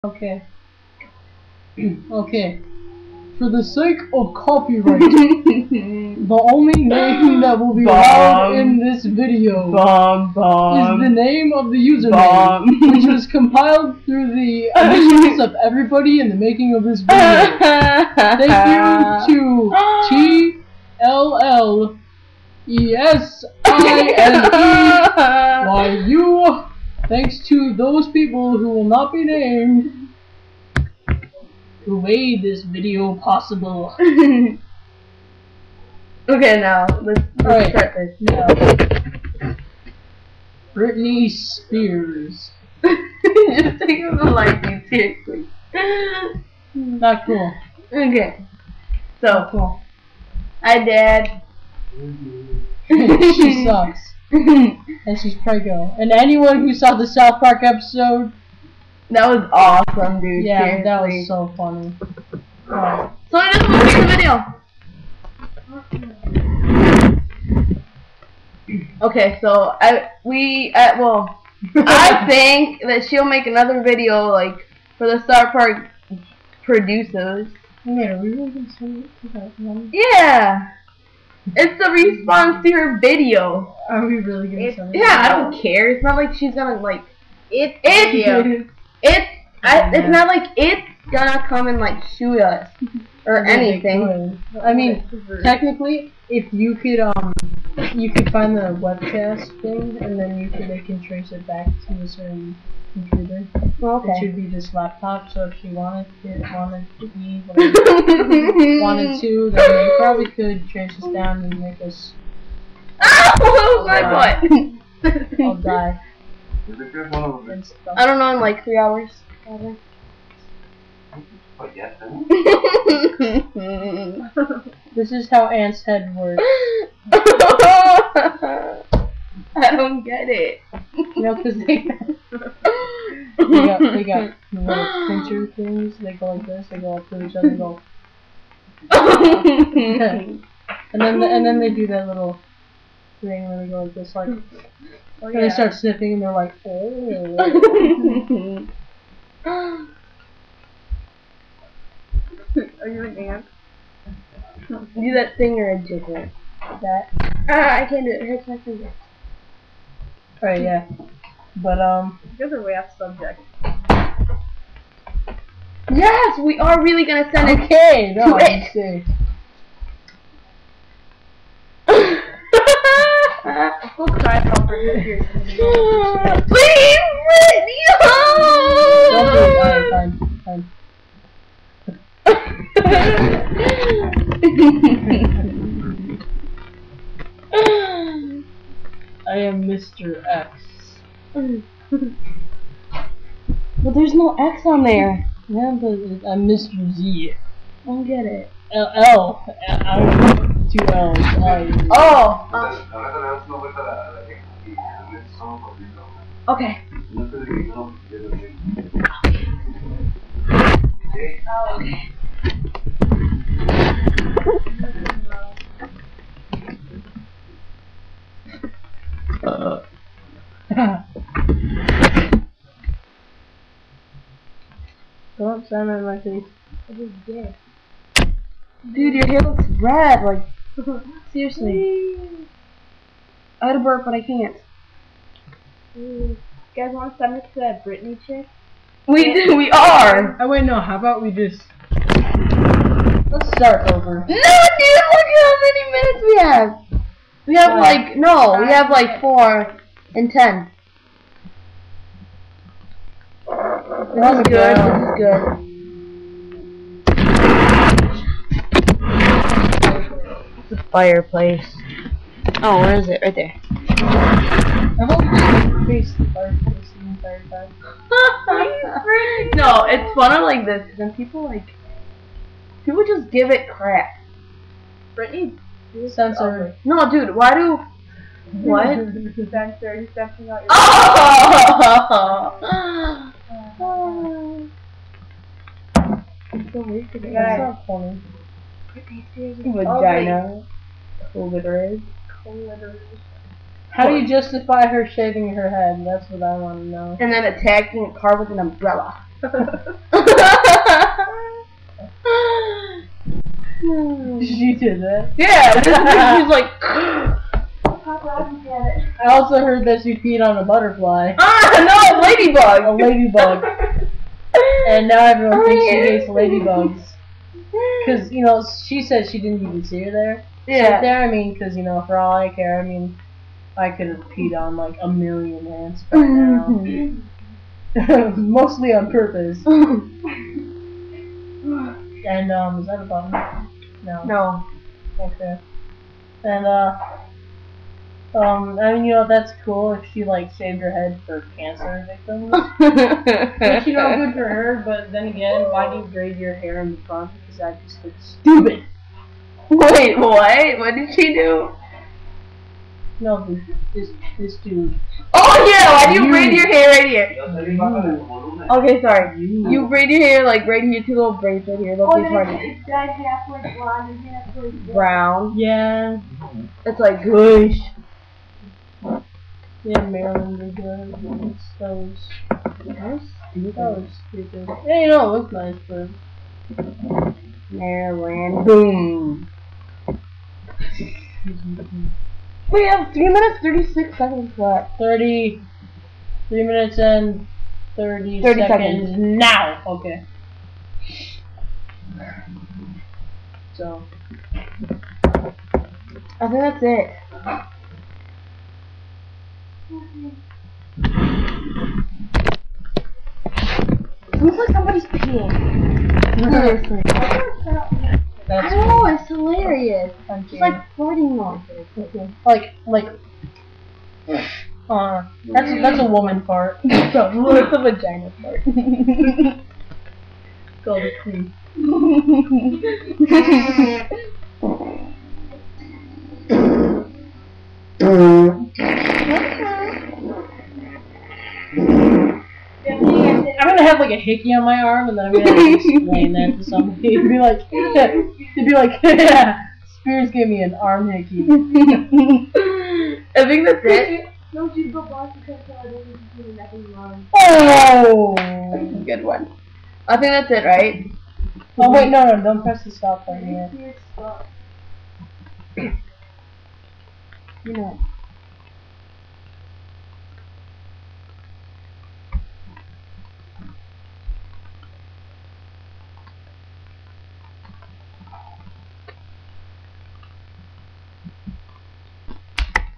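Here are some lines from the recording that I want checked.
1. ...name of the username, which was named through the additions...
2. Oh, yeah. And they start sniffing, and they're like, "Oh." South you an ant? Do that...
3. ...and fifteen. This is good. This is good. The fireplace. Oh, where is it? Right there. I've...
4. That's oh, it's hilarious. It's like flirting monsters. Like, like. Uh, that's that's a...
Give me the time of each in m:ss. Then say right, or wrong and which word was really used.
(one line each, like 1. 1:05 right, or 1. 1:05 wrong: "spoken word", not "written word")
1. 0:11 wrong: "compiled", not "named"
2. 2:25 wrong: "Are", not "South"
3. 4:10 wrong: "ten", not "fifteen"
4. 6:48 right.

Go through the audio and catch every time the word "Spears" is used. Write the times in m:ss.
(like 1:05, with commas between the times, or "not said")
0:41, 7:19.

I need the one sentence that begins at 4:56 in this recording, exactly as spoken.
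That's what I want to know.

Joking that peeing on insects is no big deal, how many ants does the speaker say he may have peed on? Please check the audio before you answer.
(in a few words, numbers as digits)
A million.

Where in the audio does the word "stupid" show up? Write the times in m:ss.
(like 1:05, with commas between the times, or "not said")
5:48, 6:14.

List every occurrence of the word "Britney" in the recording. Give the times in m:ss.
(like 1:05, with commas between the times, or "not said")
0:40, 2:57, 3:57, 4:35.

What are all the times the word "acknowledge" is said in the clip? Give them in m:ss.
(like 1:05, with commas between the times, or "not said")
not said.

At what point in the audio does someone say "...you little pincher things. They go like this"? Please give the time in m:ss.
2:14.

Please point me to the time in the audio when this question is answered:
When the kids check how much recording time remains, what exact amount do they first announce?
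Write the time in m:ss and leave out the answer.
6:23.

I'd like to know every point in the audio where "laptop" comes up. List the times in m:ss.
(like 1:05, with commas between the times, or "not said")
1:44.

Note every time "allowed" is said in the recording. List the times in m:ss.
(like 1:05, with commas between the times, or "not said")
0:07.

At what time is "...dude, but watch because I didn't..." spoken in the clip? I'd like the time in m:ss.
7:24.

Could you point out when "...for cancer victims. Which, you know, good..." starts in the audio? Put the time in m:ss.
5:41.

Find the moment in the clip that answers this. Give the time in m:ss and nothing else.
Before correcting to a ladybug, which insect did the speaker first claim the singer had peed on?
5:10.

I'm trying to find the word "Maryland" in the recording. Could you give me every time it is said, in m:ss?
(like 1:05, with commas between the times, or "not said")
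6:10, 6:17.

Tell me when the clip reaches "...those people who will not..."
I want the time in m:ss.
0:27.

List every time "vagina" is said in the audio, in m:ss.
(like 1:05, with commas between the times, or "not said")
4:49, 6:57.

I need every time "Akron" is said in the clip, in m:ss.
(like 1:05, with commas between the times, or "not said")
not said.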